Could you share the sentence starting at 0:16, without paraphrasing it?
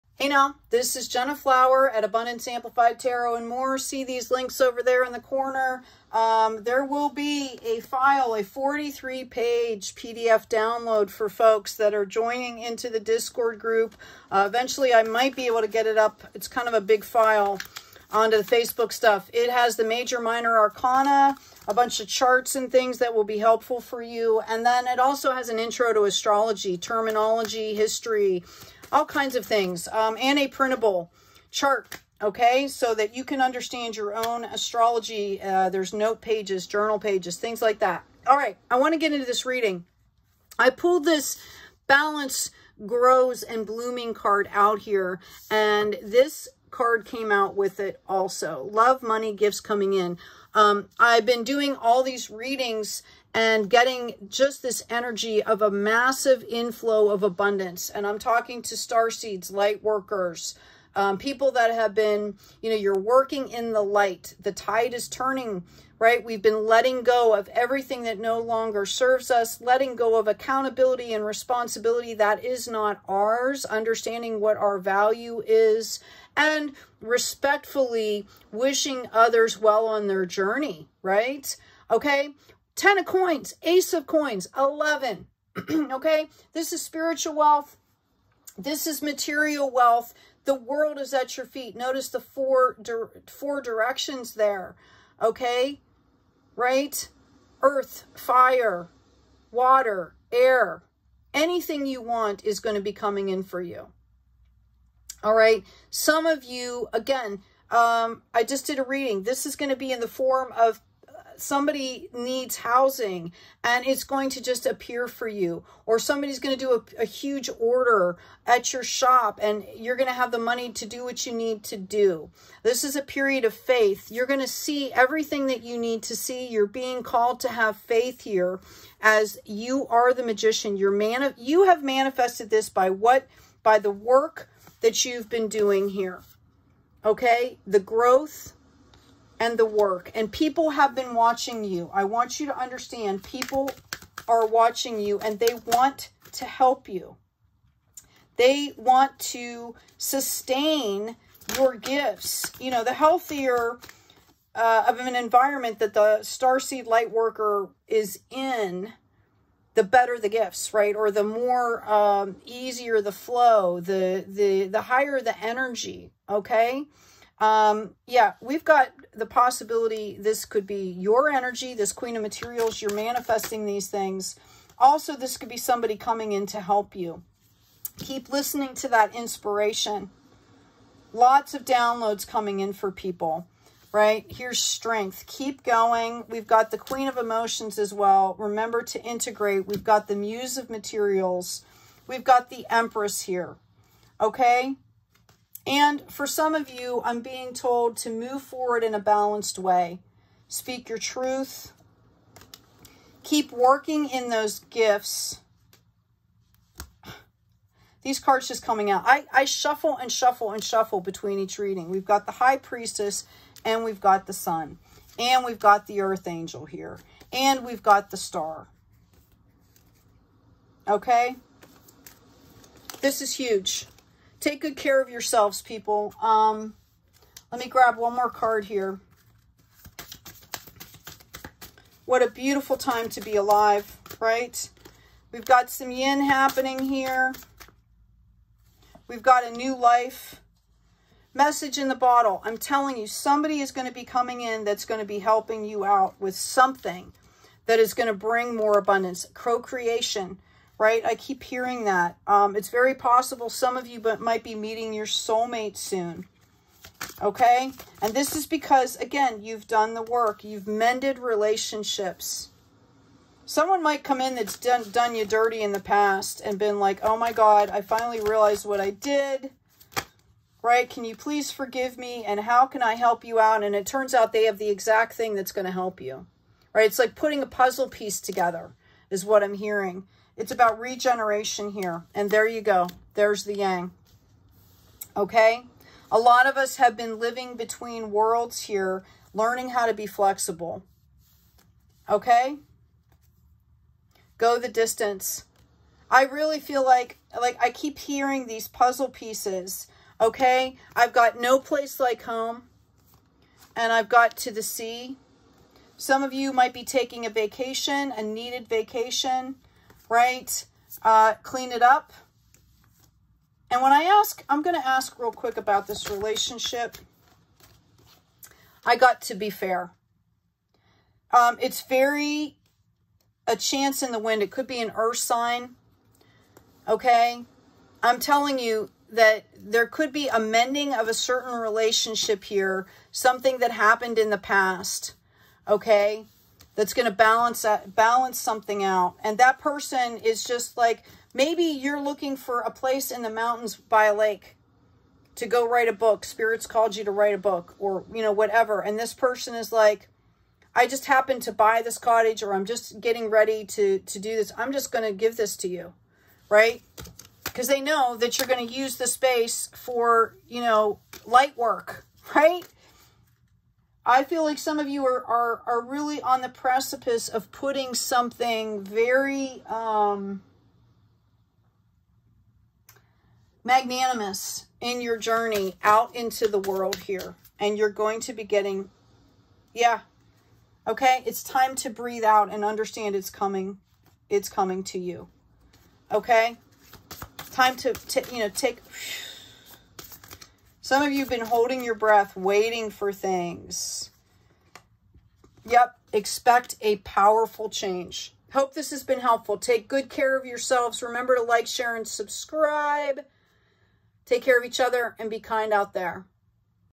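It's kind of a big file onto the Facebook stuff.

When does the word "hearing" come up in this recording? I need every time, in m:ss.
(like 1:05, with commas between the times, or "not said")
4:11, 4:39, 4:57.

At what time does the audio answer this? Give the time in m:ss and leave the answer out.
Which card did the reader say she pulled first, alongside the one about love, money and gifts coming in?
0:41.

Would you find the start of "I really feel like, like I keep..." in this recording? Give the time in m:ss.
4:56.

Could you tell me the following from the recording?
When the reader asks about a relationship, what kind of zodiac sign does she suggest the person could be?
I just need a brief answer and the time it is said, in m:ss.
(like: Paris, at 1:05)
an earth sign, at 5:24.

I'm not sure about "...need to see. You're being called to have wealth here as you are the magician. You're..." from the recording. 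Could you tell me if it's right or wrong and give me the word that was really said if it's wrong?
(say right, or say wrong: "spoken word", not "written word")
wrong: "faith", not "wealth".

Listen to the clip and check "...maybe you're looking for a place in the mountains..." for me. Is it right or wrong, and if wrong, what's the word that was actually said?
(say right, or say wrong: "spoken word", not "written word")
right.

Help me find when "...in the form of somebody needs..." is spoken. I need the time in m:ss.
1:49.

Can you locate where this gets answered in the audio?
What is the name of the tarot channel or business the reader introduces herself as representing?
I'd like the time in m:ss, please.
0:02.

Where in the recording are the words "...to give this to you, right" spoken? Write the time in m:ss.
5:55.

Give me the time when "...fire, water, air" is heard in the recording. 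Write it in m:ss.
1:38.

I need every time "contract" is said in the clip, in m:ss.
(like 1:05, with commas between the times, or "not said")
not said.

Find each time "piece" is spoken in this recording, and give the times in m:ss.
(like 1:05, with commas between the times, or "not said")
4:37, 4:59.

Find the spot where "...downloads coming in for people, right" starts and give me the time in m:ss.
3:01.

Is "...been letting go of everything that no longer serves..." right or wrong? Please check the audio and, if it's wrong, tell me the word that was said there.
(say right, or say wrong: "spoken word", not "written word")
right.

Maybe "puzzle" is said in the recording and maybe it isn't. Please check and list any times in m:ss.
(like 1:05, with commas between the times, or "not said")
4:37, 4:58.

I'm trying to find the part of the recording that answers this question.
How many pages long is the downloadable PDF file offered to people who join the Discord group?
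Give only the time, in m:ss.
0:08.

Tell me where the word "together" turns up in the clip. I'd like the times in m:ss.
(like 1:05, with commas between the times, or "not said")
4:38.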